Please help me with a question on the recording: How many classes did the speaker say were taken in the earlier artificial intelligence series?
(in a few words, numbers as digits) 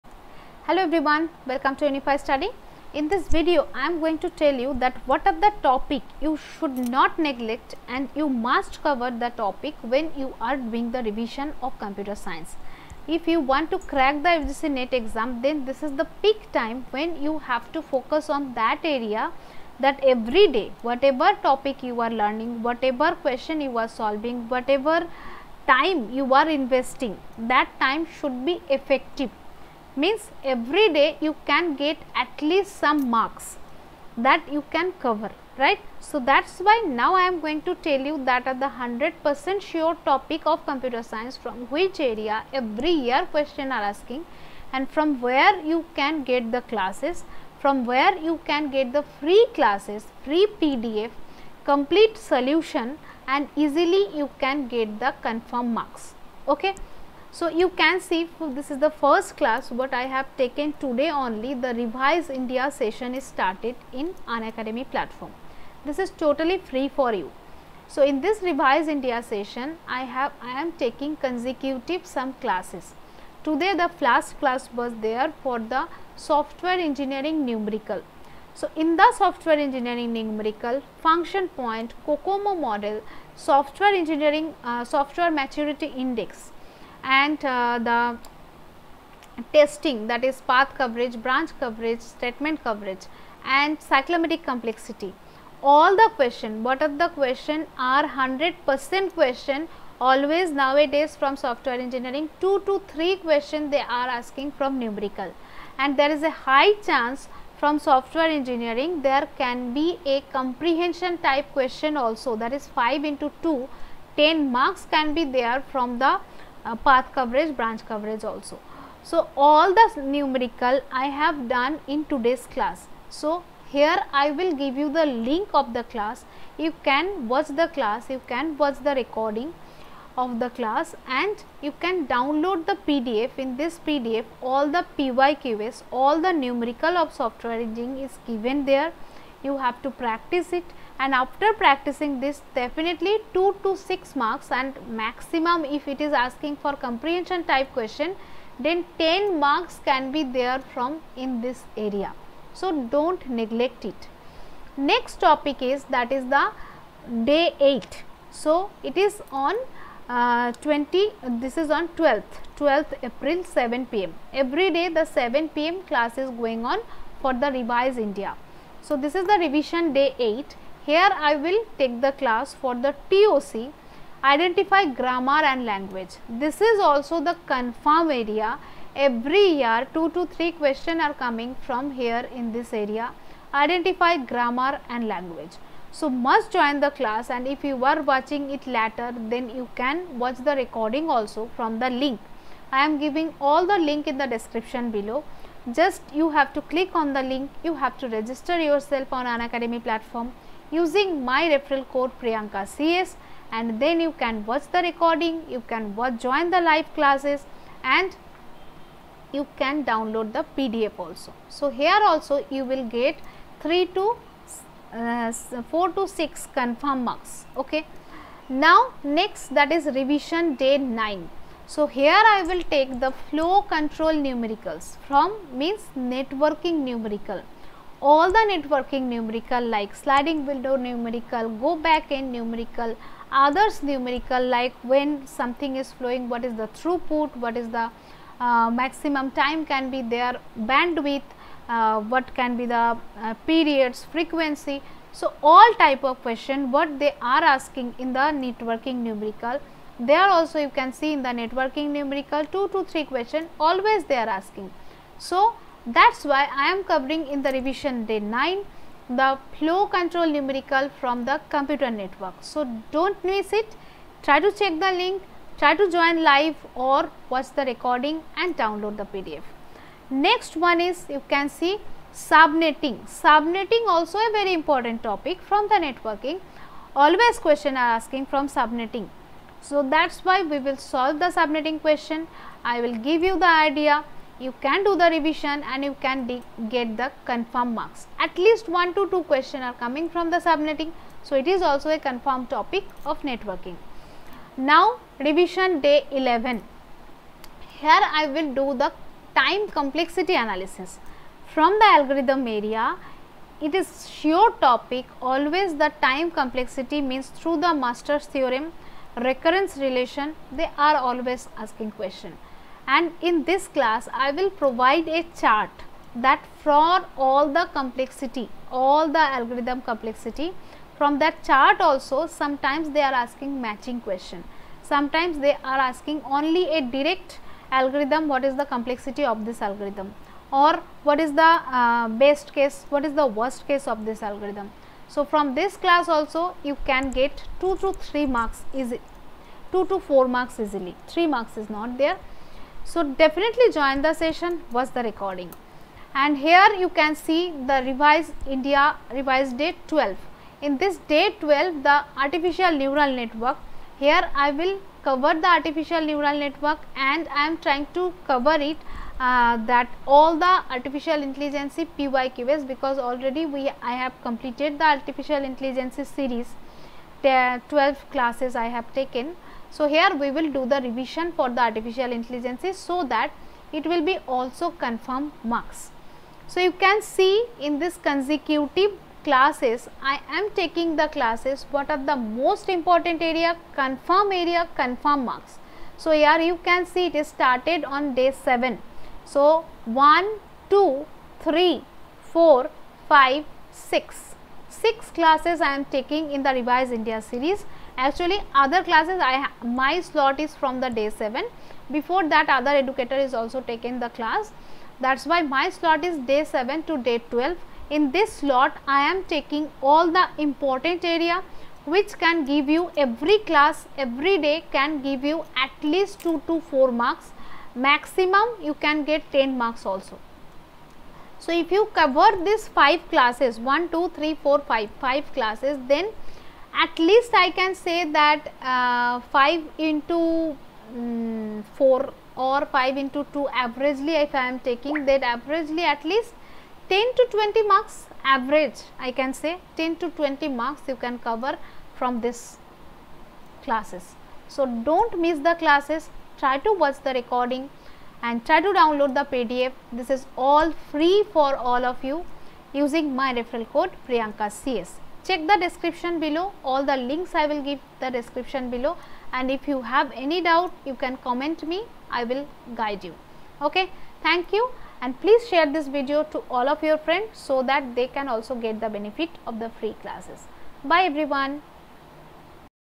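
12.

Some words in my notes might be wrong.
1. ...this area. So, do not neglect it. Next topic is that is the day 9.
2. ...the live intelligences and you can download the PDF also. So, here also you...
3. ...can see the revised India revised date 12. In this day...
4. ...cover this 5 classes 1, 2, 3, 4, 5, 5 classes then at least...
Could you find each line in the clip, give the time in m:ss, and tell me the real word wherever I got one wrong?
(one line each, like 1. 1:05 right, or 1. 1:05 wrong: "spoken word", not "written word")
1. 2:31 wrong: "8", not "9"
2. 3:26 wrong: "classes", not "intelligences"
3. 5:46 right
4. 7:01 right.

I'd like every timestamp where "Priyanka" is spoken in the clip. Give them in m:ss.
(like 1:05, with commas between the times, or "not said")
3:22, 7:34.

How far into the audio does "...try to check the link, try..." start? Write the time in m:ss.
4:24.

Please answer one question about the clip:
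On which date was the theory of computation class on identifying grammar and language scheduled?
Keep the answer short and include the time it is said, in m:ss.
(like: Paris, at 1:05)
12th April, at 2:42.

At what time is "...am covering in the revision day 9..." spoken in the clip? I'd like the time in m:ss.
4:16.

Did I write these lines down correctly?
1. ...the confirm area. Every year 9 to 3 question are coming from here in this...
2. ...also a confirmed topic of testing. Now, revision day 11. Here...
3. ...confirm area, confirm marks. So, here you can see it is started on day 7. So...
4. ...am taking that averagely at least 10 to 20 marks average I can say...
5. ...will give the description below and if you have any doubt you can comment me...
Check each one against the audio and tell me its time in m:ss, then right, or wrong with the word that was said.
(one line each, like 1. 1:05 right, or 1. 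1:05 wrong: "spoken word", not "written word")
1. 2:57 wrong: "2", not "9"
2. 4:51 wrong: "networking", not "testing"
3. 6:23 right
4. 7:14 right
5. 7:37 right.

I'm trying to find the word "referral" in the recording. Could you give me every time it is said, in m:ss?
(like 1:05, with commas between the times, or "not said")
3:21, 7:33.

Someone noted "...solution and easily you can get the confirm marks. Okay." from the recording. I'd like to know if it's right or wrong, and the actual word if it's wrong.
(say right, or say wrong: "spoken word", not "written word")
right.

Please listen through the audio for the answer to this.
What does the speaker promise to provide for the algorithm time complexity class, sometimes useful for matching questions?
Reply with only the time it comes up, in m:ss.
5:15.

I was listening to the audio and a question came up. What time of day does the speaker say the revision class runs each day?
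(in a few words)
7 pm.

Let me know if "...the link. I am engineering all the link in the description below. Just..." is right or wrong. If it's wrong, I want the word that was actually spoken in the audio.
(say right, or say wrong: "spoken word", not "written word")
wrong: "giving", not "engineering".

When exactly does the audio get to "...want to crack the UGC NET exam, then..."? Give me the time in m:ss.
0:13.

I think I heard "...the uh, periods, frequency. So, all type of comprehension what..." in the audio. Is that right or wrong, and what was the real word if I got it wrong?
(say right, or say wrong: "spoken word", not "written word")
wrong: "question", not "comprehension".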